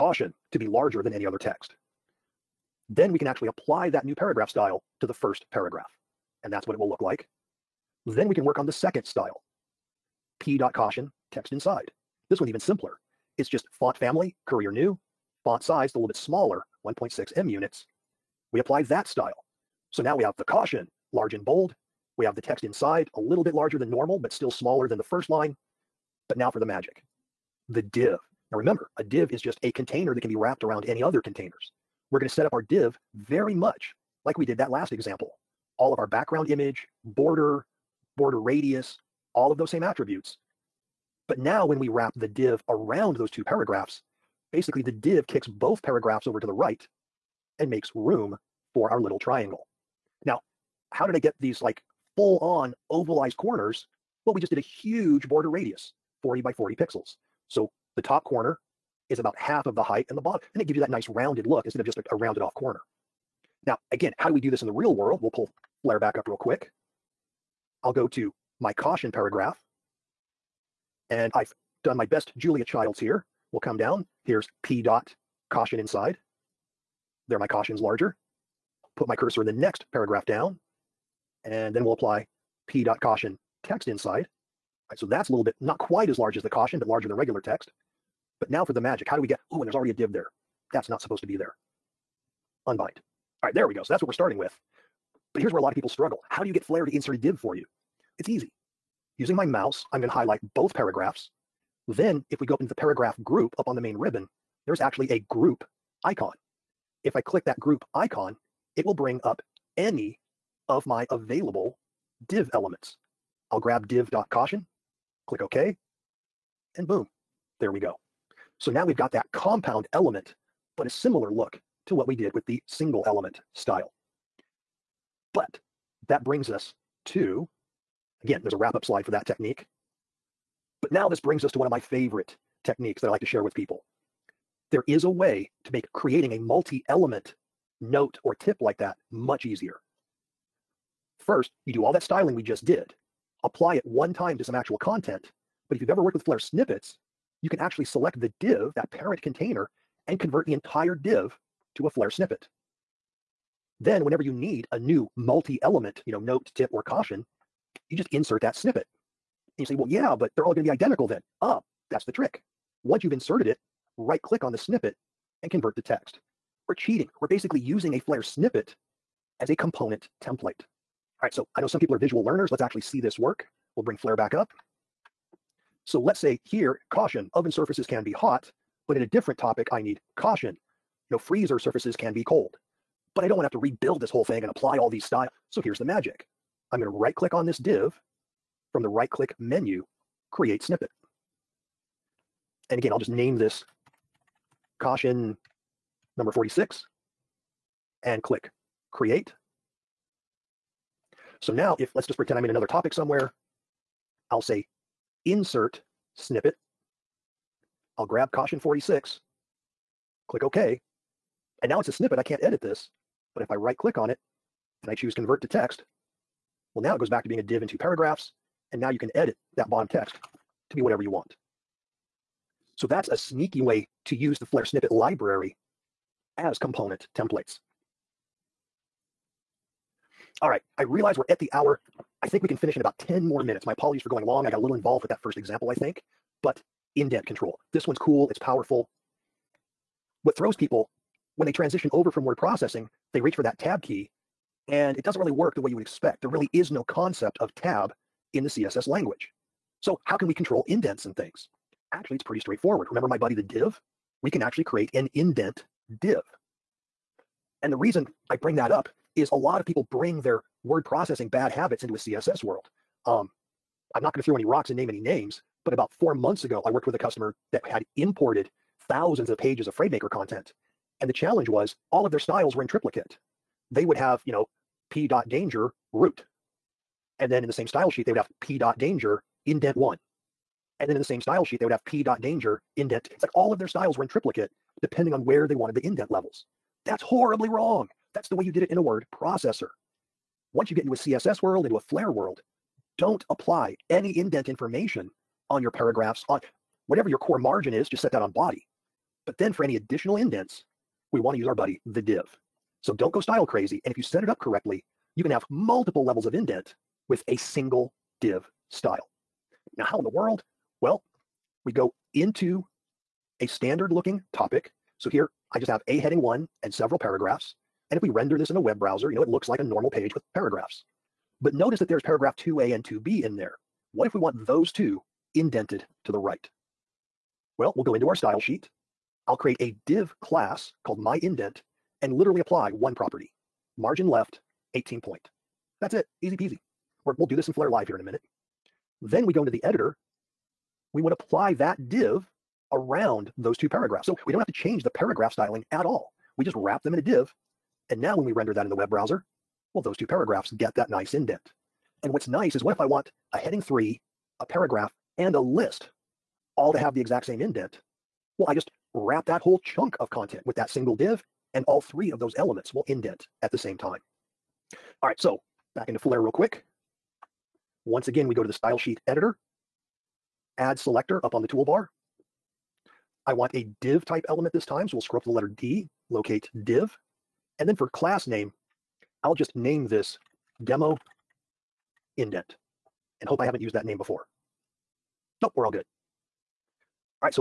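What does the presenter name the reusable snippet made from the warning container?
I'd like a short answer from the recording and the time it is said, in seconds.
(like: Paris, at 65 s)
caution number 46, at 194 s.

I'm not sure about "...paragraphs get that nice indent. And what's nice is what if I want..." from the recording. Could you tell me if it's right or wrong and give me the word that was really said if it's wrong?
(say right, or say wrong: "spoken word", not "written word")
right.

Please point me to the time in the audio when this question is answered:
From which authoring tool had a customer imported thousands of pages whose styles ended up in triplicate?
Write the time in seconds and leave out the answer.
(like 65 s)
269 s.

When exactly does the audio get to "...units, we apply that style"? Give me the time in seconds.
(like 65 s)
17 s.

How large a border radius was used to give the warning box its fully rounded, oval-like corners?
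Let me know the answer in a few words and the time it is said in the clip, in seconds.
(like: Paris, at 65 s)
40 by 40 pixels, at 56 s.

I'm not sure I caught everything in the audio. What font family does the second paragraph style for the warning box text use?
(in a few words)
Courier New.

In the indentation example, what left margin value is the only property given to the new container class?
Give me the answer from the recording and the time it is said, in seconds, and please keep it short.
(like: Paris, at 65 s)
18 point, at 334 s.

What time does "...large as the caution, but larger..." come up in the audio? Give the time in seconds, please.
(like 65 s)
86 s.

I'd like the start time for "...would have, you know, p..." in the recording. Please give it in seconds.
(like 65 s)
273 s.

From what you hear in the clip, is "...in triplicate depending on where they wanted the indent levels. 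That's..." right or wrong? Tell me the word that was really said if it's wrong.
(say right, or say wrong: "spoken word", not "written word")
right.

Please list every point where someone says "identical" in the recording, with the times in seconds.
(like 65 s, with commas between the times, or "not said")
160 s.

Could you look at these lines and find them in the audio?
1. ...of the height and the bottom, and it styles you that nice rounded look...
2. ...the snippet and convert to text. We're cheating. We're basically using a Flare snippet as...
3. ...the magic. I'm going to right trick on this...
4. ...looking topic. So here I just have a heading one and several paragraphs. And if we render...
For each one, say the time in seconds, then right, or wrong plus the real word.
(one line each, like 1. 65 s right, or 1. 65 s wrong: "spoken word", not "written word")
1. 59 s wrong: "gives", not "styles"
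2. 164 s right
3. 185 s wrong: "click", not "trick"
4. 313 s right.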